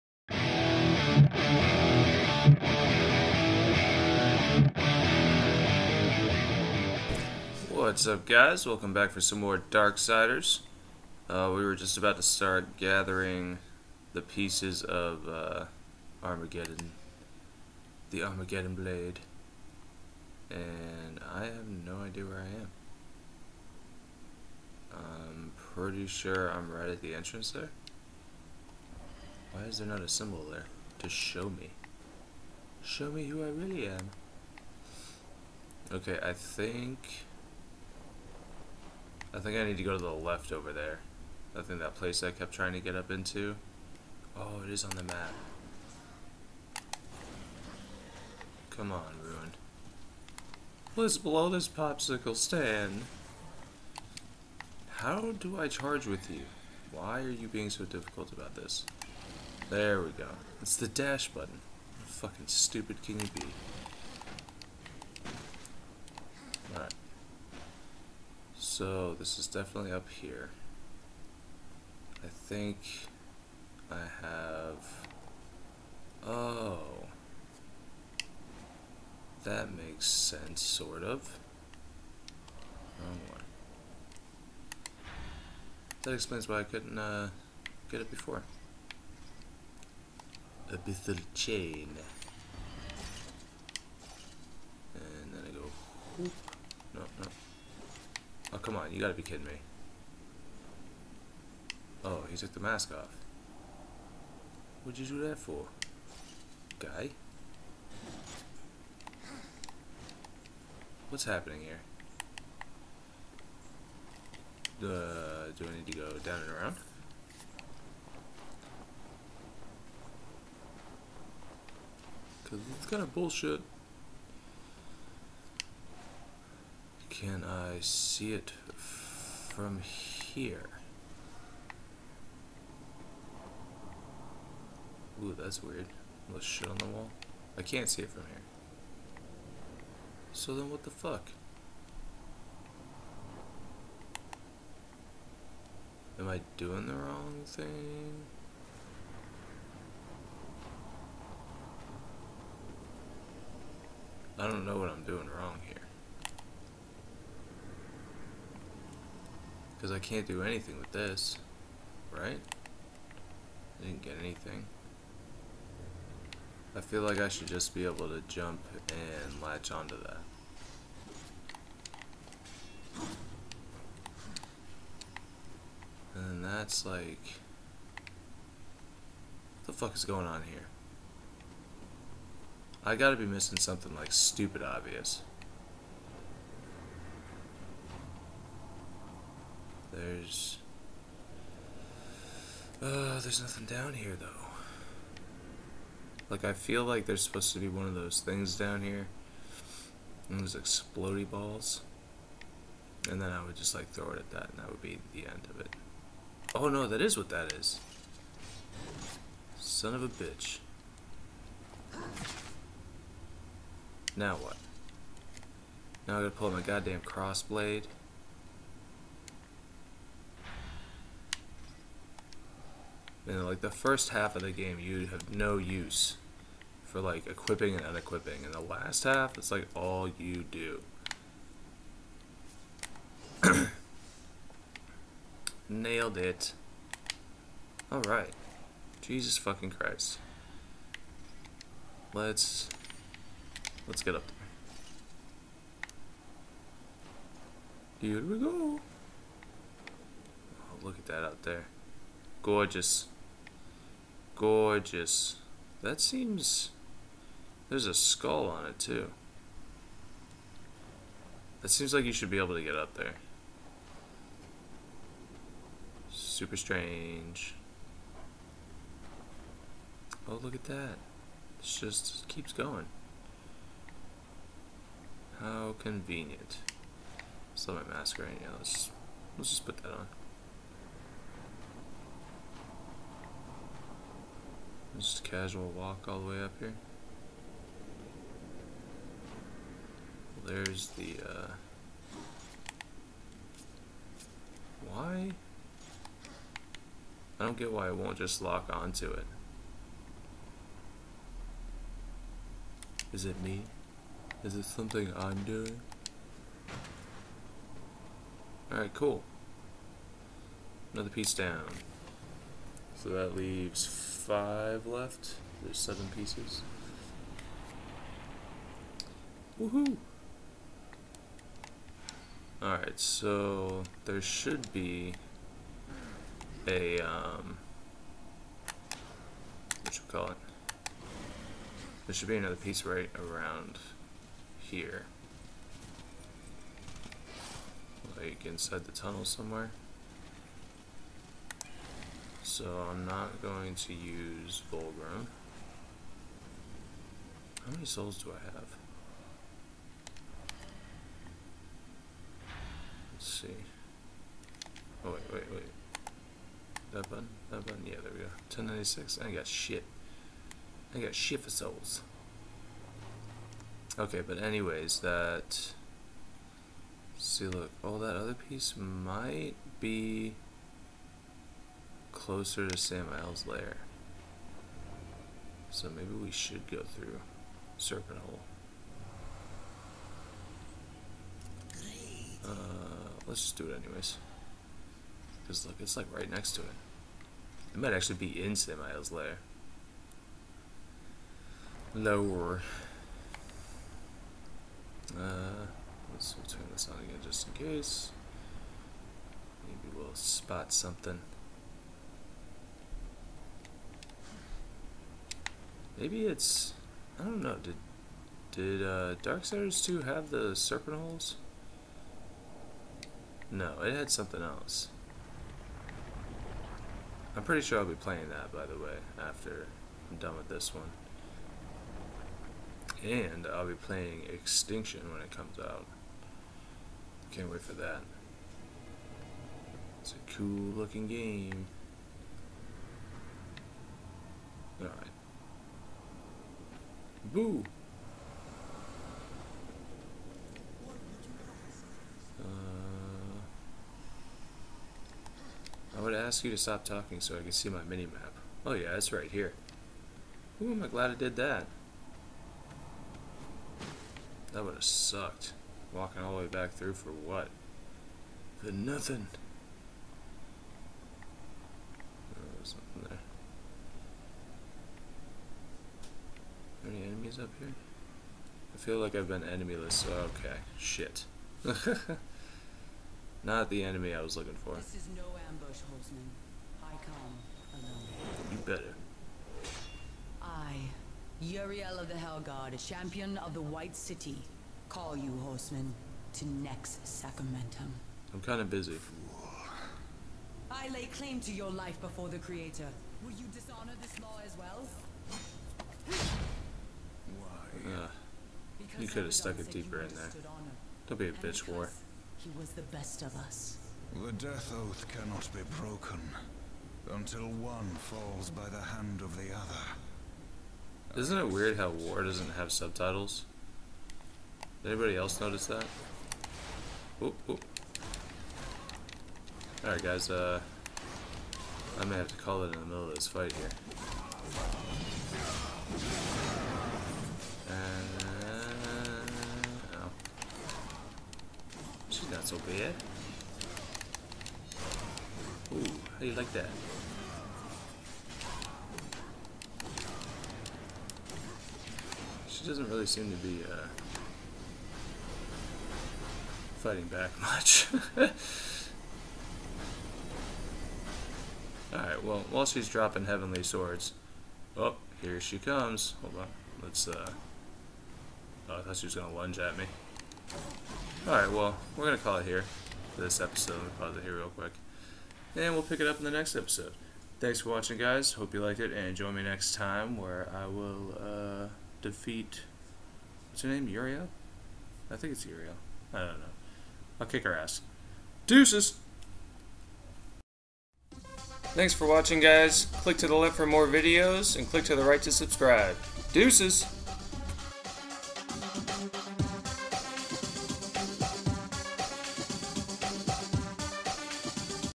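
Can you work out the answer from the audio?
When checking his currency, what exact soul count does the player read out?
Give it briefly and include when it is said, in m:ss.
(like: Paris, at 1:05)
1096, at 5:58.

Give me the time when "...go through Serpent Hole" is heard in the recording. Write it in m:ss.
6:16.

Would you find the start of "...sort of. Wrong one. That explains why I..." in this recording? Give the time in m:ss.
1:20.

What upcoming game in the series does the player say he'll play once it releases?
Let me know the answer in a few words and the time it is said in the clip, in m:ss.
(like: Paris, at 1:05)
Extinction, at 7:04.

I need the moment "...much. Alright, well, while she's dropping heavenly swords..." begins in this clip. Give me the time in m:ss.
9:07.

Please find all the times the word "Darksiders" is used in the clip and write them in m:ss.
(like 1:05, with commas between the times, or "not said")
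0:09, 6:49.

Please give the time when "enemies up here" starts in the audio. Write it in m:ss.
7:47.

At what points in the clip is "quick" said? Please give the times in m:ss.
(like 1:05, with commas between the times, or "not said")
9:24.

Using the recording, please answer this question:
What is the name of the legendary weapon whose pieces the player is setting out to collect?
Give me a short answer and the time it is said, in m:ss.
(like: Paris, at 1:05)
Armageddon Blade, at 0:18.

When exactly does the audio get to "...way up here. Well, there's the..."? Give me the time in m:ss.
4:46.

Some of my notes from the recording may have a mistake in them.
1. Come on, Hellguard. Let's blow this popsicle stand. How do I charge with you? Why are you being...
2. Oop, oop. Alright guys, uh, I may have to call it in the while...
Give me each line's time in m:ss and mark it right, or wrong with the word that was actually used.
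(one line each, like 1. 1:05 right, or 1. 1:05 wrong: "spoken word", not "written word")
1. 0:48 wrong: "Ruin", not "Hellguard"
2. 8:37 wrong: "middle", not "while".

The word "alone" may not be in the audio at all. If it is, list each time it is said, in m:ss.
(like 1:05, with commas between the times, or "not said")
7:57.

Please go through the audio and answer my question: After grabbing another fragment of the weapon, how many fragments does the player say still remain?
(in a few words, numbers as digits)
5.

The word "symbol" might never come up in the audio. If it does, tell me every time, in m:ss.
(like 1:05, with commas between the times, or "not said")
0:30.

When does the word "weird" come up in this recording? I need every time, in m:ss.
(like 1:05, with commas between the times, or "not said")
2:15, 8:31.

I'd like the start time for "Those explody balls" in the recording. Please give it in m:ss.
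3:20.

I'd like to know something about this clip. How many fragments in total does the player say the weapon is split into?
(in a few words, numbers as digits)
7.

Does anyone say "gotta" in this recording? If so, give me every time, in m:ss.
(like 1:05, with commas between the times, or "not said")
1:38, 3:02, 3:36.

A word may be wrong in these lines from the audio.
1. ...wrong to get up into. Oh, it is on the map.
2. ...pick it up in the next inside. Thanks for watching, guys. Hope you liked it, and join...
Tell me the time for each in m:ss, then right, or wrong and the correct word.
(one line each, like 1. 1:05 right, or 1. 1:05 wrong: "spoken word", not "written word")
1. 0:42 wrong: "trying", not "wrong"
2. 9:25 wrong: "episode", not "inside".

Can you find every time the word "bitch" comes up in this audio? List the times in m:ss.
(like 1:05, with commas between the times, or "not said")
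3:30, 8:21.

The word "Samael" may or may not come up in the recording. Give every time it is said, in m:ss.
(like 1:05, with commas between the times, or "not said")
6:12, 6:28.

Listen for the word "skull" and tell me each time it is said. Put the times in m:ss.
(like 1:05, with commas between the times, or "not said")
4:17.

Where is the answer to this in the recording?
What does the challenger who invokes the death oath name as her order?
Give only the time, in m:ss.
8:02.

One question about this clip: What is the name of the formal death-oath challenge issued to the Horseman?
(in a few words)
Nex Sacramentum.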